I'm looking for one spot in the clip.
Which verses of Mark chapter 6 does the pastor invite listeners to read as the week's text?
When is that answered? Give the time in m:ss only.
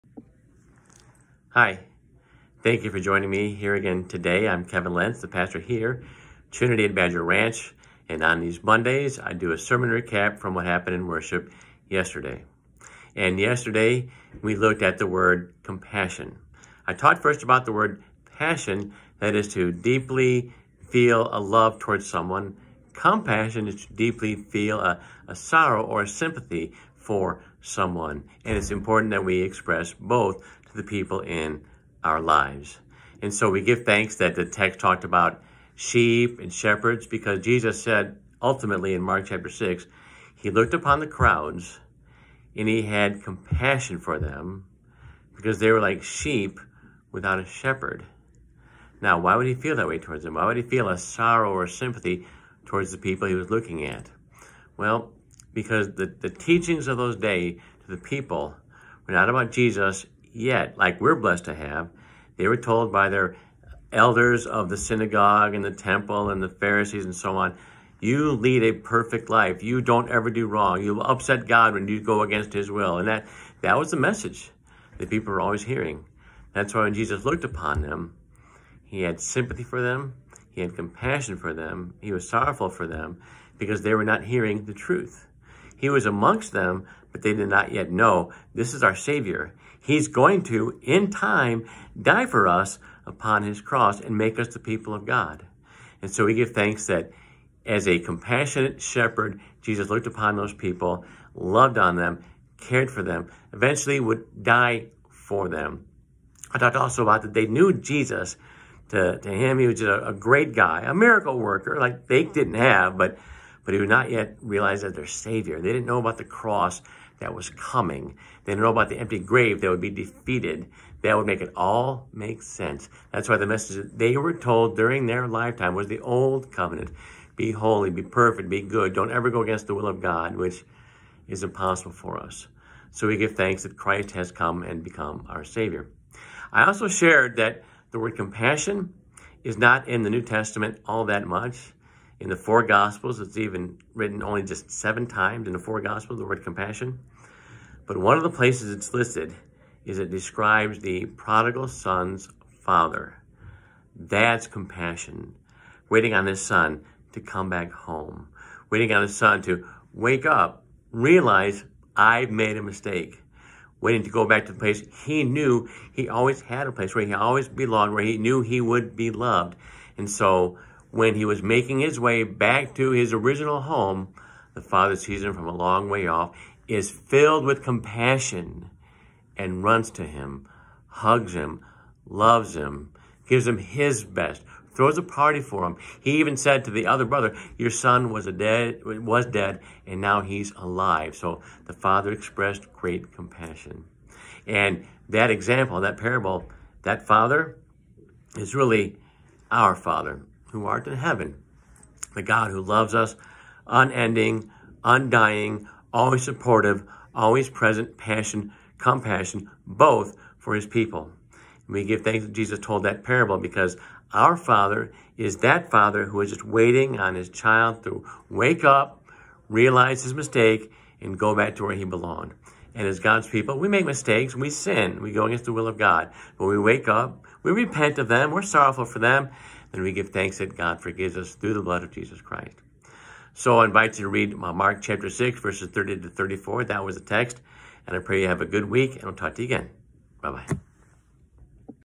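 3:55.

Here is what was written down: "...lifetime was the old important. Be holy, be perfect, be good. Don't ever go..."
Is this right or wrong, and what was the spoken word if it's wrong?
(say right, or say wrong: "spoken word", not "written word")
wrong: "covenant", not "important".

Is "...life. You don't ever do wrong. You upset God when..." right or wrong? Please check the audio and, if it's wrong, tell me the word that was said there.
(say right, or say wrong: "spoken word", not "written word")
right.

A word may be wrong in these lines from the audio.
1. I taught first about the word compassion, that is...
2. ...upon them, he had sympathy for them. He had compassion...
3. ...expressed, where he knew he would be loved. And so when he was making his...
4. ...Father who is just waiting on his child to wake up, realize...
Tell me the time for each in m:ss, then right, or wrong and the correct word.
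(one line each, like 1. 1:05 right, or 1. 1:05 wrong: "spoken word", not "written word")
1. 0:16 wrong: "passion", not "compassion"
2. 1:17 right
3. 2:47 wrong: "belonged", not "expressed"
4. 3:35 right.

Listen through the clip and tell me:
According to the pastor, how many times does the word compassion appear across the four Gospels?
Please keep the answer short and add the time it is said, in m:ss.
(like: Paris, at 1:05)
7, at 2:24.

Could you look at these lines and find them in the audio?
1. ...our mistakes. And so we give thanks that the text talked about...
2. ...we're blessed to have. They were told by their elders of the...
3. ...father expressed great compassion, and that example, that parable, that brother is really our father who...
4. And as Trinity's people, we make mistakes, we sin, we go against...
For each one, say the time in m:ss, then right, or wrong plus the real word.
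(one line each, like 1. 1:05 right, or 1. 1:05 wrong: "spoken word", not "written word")
1. 0:32 wrong: "lives", not "mistakes"
2. 1:01 right
3. 3:11 wrong: "father", not "brother"
4. 3:42 wrong: "God", not "Trinity".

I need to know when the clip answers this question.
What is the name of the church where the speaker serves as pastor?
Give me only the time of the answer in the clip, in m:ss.
0:06.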